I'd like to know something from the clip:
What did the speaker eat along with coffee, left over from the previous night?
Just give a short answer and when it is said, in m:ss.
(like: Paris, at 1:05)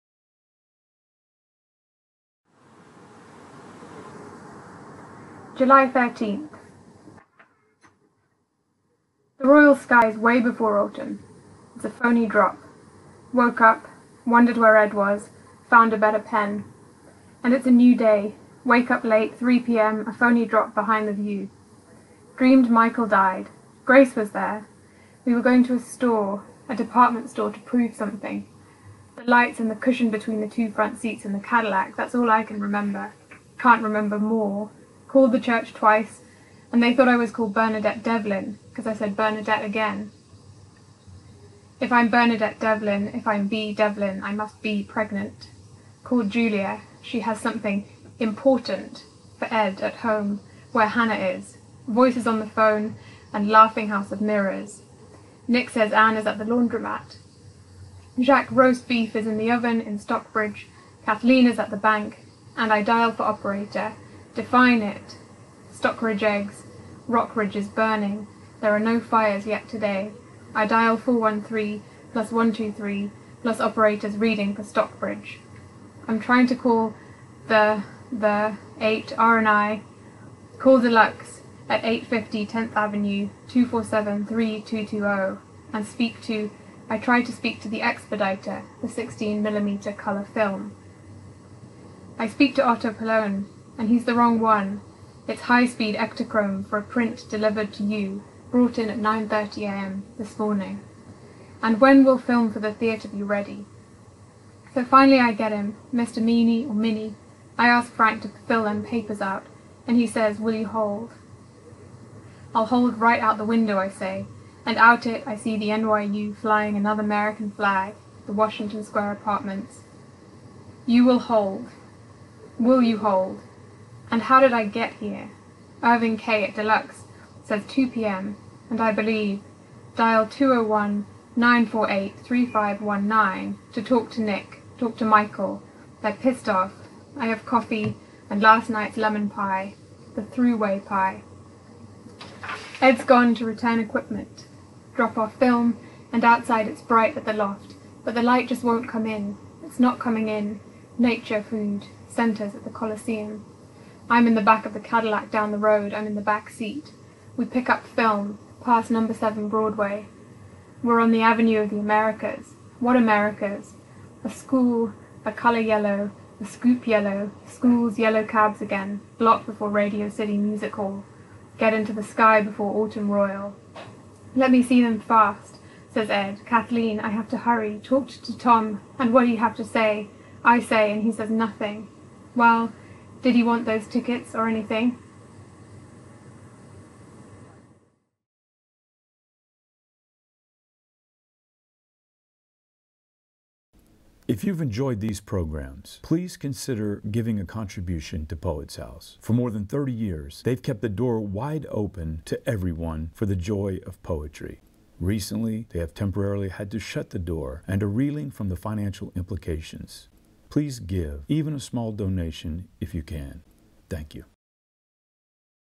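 lemon pie, at 2:18.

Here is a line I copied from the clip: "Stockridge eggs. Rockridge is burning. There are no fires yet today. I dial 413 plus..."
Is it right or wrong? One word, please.
right.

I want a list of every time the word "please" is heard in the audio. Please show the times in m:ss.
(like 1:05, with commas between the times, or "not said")
3:16, 3:30.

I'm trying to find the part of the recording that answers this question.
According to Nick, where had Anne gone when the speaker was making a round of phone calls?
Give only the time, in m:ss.
0:56.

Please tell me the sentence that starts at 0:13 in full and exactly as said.
Woke up, wondered where Ed was, found a better pen.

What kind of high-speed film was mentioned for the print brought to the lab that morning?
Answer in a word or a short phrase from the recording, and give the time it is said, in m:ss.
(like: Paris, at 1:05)
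Ektachrome, at 1:35.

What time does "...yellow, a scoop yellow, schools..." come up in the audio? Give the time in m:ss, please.
2:45.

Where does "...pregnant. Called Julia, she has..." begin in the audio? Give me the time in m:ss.
0:44.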